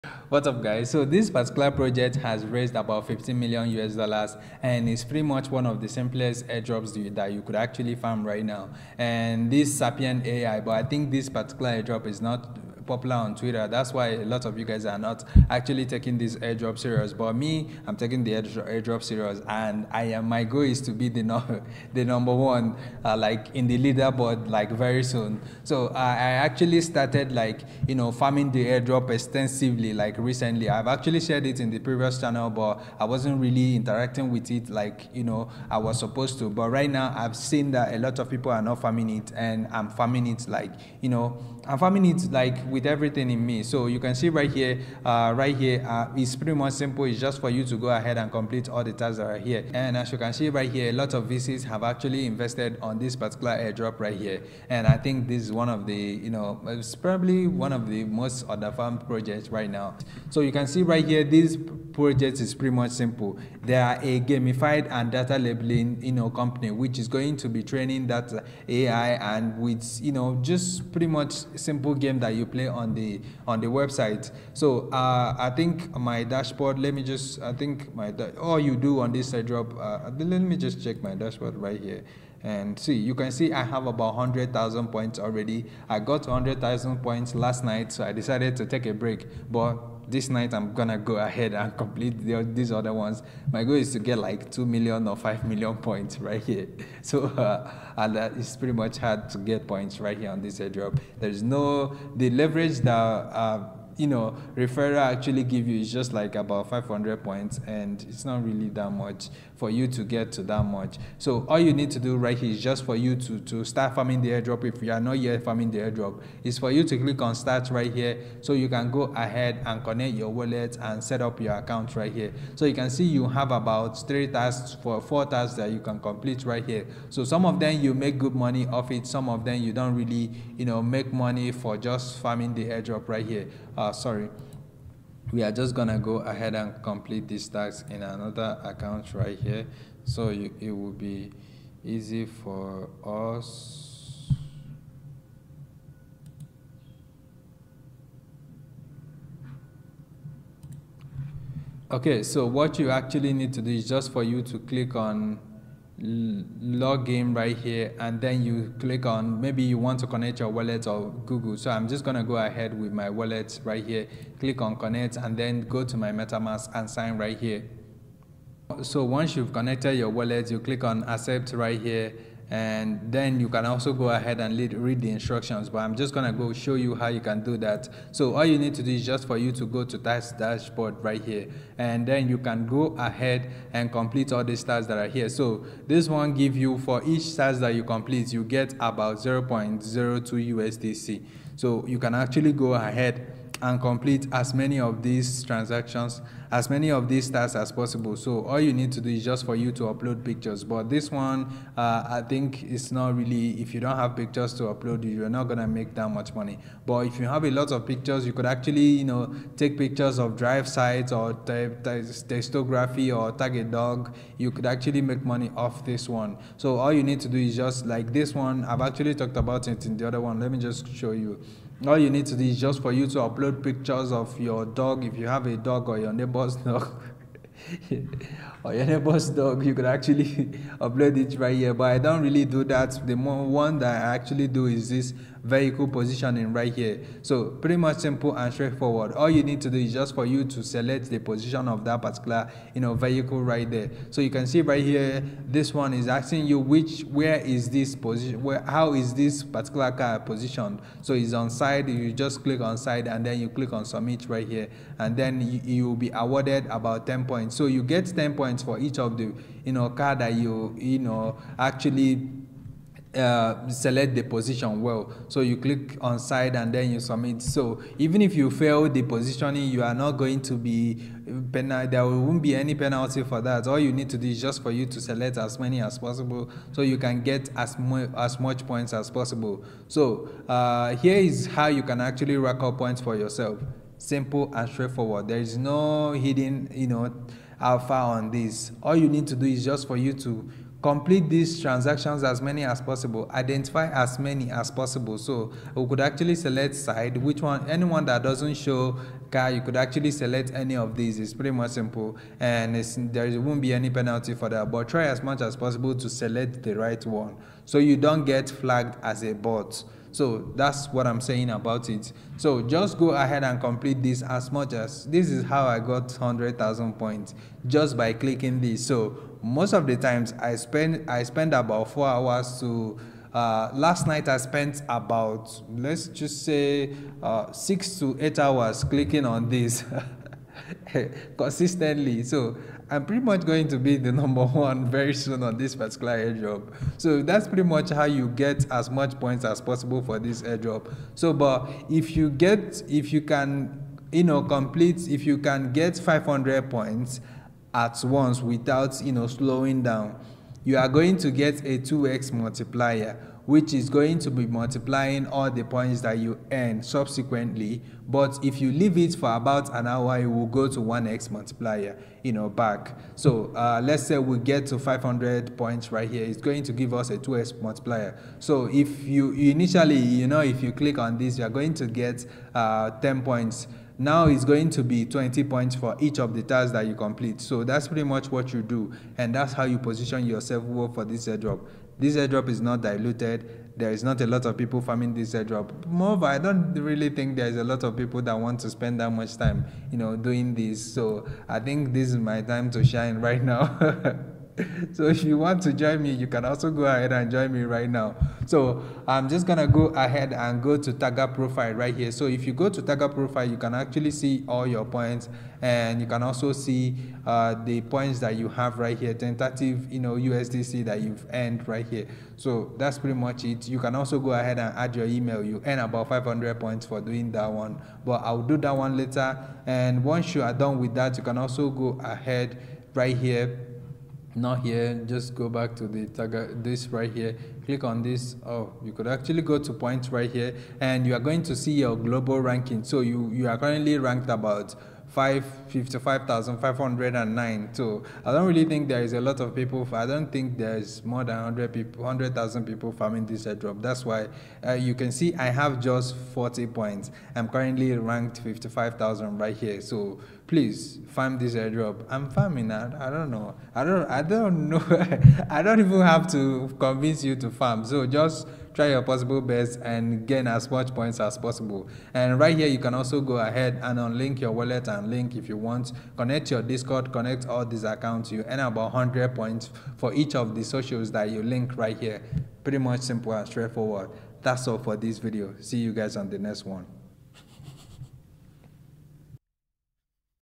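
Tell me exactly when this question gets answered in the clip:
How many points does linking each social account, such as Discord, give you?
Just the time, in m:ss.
7:48.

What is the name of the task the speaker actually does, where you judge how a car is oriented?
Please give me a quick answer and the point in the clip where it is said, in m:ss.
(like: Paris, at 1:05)
vehicle positioning, at 3:55.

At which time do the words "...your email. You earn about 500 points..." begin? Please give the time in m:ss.
6:54.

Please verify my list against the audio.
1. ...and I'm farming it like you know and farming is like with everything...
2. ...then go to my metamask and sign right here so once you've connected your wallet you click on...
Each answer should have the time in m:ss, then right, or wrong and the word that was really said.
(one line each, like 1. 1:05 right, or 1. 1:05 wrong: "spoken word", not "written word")
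1. 0:39 right
2. 2:45 right.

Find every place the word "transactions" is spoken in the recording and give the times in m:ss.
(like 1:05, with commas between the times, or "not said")
3:15, 4:51.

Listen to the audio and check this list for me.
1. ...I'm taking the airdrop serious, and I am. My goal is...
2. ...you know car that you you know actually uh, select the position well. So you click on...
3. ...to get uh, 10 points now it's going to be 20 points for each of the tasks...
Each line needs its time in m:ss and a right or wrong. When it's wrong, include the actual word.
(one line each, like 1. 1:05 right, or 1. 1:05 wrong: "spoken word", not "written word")
1. 0:17 right
2. 4:19 right
3. 6:11 right.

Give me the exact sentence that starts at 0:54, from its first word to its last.
And I think this is one of the, you know, it's probably one of the most underfarmed projects right now.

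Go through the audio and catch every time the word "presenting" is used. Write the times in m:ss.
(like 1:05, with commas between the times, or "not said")
not said.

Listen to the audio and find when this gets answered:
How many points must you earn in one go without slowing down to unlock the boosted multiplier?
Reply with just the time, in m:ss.
5:45.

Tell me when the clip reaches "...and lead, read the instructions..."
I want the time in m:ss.
2:54.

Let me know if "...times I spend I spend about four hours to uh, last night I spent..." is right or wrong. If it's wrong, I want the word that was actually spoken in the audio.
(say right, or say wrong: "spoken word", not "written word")
right.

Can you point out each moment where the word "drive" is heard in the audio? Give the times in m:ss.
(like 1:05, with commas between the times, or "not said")
3:30.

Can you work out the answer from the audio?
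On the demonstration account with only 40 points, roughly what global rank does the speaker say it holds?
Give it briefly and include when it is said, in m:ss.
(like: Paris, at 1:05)
55,000, at 7:28.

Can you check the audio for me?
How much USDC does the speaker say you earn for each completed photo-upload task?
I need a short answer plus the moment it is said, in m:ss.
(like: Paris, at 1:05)
0.02 USDC, at 3:09.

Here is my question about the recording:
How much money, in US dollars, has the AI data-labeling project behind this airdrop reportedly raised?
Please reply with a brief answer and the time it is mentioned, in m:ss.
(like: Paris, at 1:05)
15 million US dollars, at 0:03.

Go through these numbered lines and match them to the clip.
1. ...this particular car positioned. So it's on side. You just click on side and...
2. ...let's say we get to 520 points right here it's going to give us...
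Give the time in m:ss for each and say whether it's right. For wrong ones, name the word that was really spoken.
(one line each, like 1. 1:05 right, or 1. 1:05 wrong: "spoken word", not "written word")
1. 4:09 right
2. 6:03 wrong: "500", not "520".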